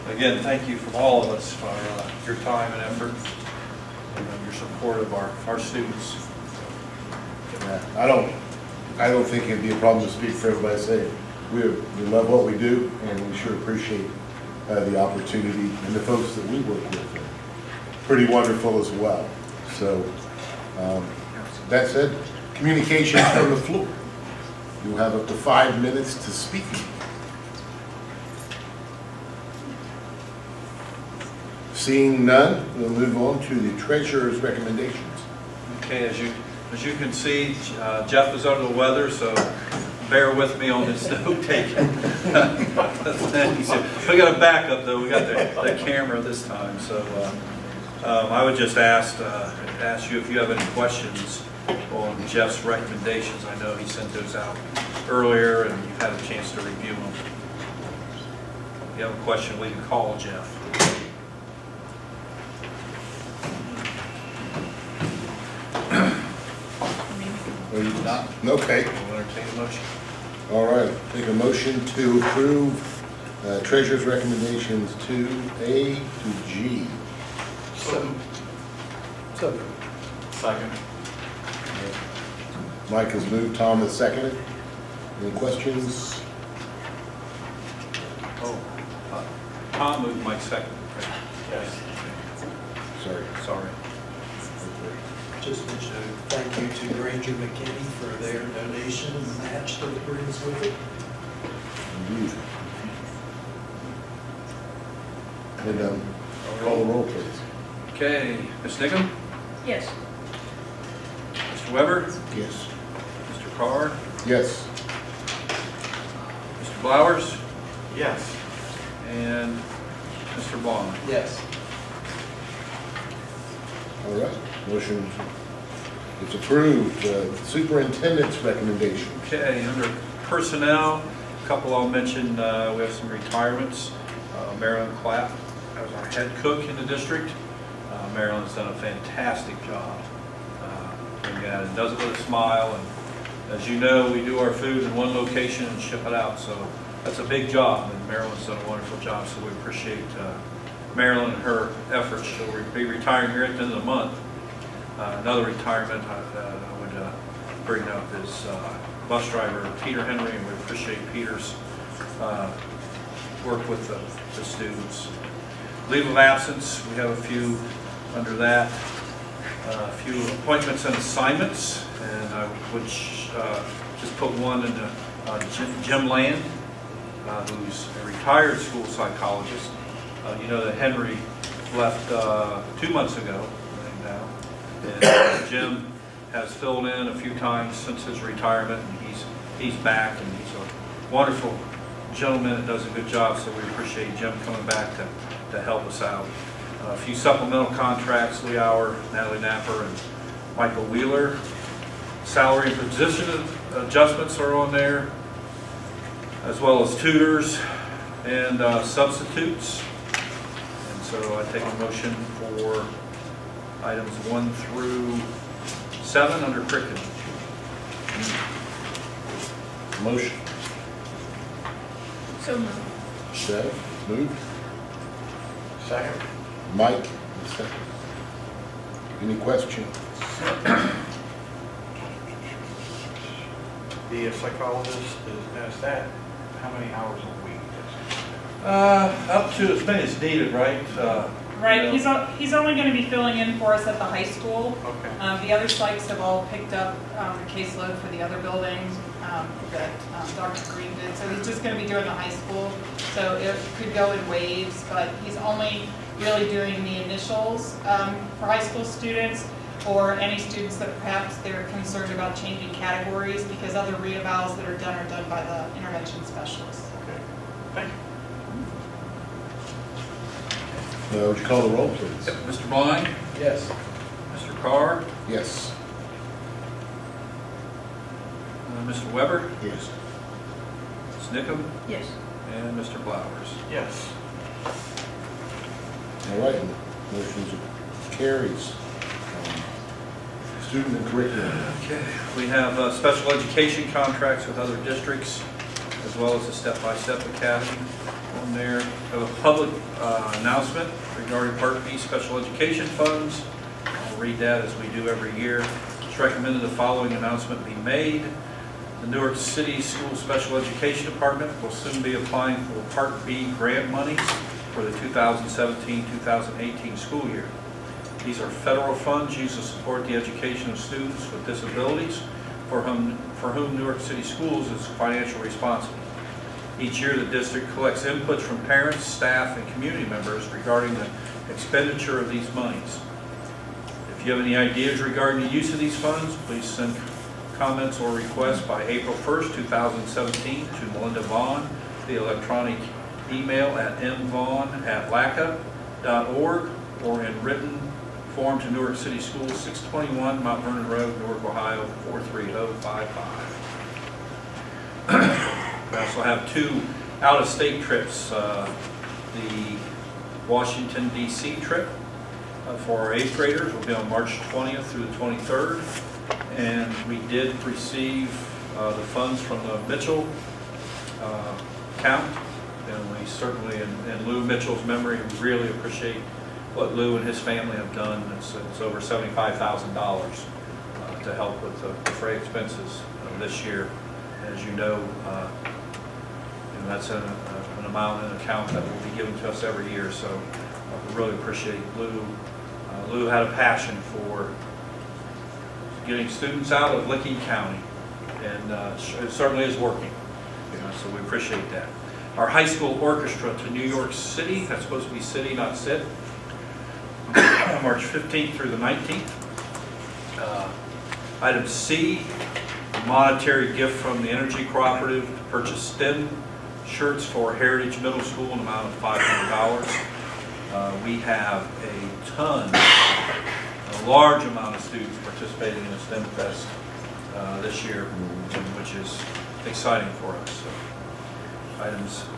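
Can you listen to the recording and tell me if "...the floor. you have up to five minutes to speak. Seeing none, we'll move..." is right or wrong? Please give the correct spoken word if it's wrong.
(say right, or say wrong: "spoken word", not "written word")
right.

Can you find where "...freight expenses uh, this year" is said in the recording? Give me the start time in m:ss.
6:22.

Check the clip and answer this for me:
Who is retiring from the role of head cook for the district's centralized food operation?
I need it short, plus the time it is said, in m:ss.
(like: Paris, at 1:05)
Marilyn Clapp, at 2:14.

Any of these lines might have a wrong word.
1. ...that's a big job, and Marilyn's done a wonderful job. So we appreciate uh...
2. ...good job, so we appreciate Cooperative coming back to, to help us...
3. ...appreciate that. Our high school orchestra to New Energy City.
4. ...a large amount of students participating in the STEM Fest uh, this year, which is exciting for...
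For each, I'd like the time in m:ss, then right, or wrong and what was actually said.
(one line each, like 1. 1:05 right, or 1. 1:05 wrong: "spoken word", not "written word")
1. 2:27 right
2. 3:12 wrong: "Jim", not "Cooperative"
3. 6:41 wrong: "York", not "Energy"
4. 7:02 right.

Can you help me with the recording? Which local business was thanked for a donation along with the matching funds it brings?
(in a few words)
Granger McKinney.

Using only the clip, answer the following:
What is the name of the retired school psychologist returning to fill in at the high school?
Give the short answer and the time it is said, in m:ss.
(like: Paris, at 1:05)
Jim Land, at 2:55.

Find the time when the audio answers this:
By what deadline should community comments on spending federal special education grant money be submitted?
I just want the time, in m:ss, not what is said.
5:38.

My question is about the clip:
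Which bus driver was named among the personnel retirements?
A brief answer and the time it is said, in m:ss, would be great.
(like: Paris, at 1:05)
Peter Henry, at 2:39.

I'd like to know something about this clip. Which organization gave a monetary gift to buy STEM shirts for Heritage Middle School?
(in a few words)
Energy Cooperative.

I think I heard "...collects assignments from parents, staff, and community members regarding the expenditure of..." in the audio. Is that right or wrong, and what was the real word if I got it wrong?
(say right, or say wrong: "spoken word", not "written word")
wrong: "inputs", not "assignments".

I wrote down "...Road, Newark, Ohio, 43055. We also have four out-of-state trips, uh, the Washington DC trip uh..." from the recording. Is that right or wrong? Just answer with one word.
wrong.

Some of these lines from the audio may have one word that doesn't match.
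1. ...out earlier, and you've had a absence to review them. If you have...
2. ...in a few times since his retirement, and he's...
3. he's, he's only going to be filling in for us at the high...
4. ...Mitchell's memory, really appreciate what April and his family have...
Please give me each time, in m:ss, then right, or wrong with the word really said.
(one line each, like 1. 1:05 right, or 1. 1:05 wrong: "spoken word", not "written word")
1. 0:54 wrong: "chance", not "absence"
2. 3:06 right
3. 4:02 right
4. 6:14 wrong: "Lou", not "April".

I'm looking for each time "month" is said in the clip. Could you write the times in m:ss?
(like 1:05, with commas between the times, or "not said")
2:33, 3:02.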